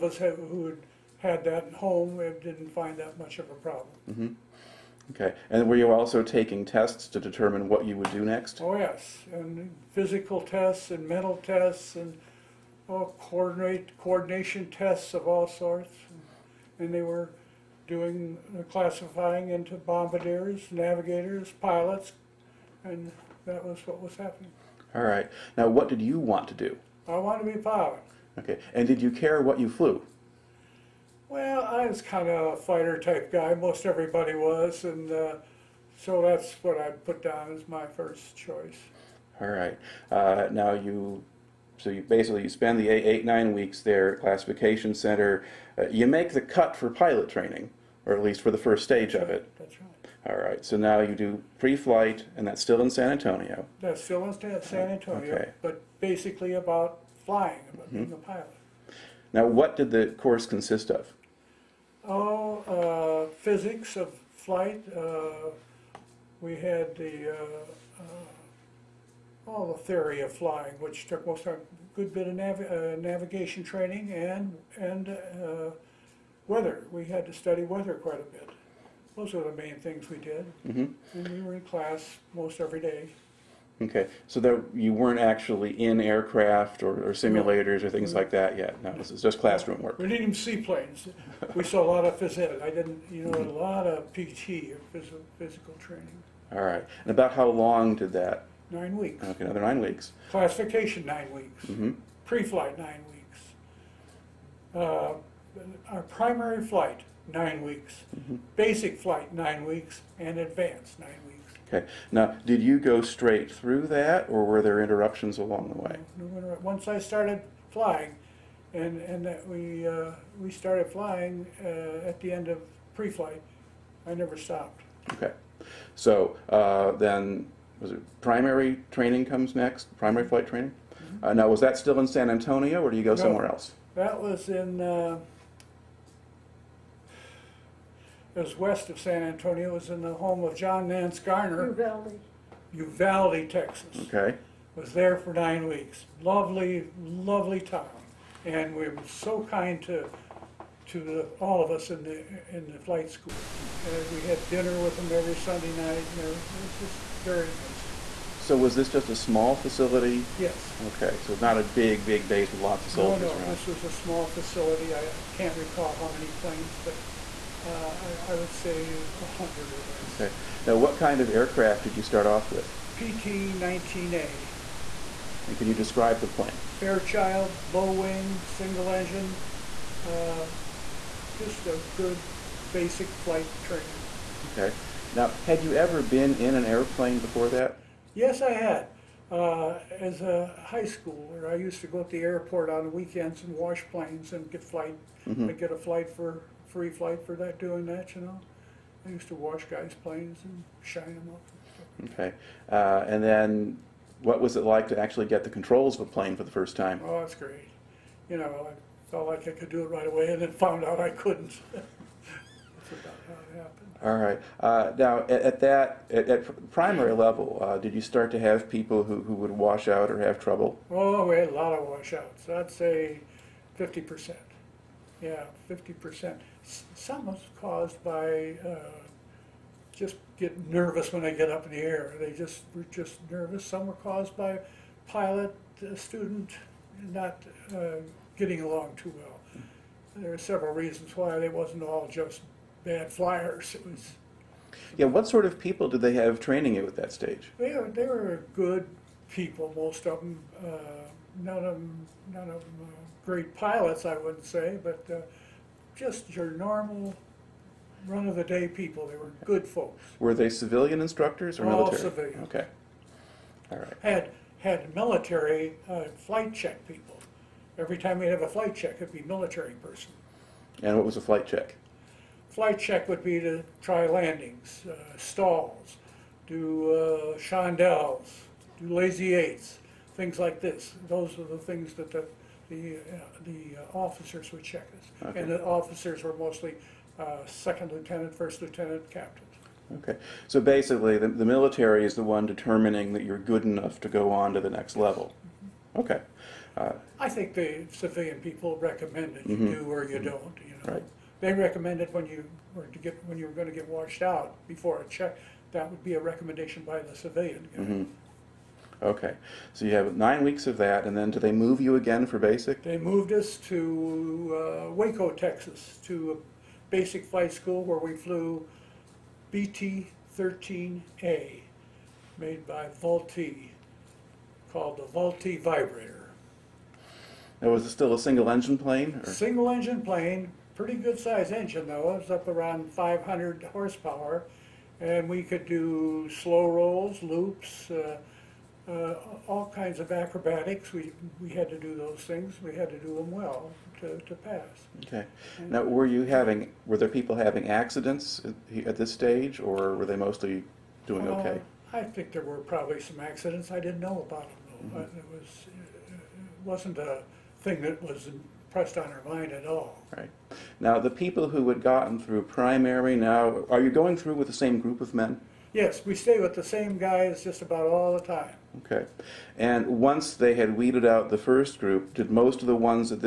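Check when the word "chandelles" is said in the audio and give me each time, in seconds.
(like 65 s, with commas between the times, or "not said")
277 s.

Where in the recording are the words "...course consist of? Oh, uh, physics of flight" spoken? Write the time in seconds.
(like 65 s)
60 s.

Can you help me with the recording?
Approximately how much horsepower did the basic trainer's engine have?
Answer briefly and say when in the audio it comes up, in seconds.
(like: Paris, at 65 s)
500, at 332 s.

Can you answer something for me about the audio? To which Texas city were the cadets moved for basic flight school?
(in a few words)
Waco.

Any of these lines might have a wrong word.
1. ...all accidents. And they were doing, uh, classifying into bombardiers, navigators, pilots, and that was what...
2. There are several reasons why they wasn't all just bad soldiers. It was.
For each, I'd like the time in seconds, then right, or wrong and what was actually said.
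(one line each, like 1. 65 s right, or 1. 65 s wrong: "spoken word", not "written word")
1. 15 s wrong: "sorts", not "accidents"
2. 240 s wrong: "flyers", not "soldiers".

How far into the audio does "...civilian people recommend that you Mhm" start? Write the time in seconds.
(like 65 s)
297 s.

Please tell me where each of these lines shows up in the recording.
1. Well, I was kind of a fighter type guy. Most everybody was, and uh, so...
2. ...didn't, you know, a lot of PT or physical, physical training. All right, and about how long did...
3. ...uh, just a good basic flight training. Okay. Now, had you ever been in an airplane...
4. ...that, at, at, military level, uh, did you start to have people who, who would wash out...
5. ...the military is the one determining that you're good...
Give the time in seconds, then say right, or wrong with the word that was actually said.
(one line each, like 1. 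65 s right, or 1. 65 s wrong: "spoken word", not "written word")
1. 31 s right
2. 92 s right
3. 180 s right
4. 215 s wrong: "primary", not "military"
5. 291 s right.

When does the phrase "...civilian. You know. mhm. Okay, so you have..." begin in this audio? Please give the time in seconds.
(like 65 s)
307 s.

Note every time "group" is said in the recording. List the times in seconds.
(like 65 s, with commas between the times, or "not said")
364 s, 371 s.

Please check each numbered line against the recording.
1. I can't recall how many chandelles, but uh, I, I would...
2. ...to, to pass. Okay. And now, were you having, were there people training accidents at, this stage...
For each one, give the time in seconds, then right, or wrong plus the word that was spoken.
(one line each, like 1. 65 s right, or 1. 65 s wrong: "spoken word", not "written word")
1. 164 s wrong: "planes", not "chandelles"
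2. 344 s wrong: "having", not "training".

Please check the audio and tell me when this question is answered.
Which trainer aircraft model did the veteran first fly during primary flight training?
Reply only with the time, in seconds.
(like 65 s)
172 s.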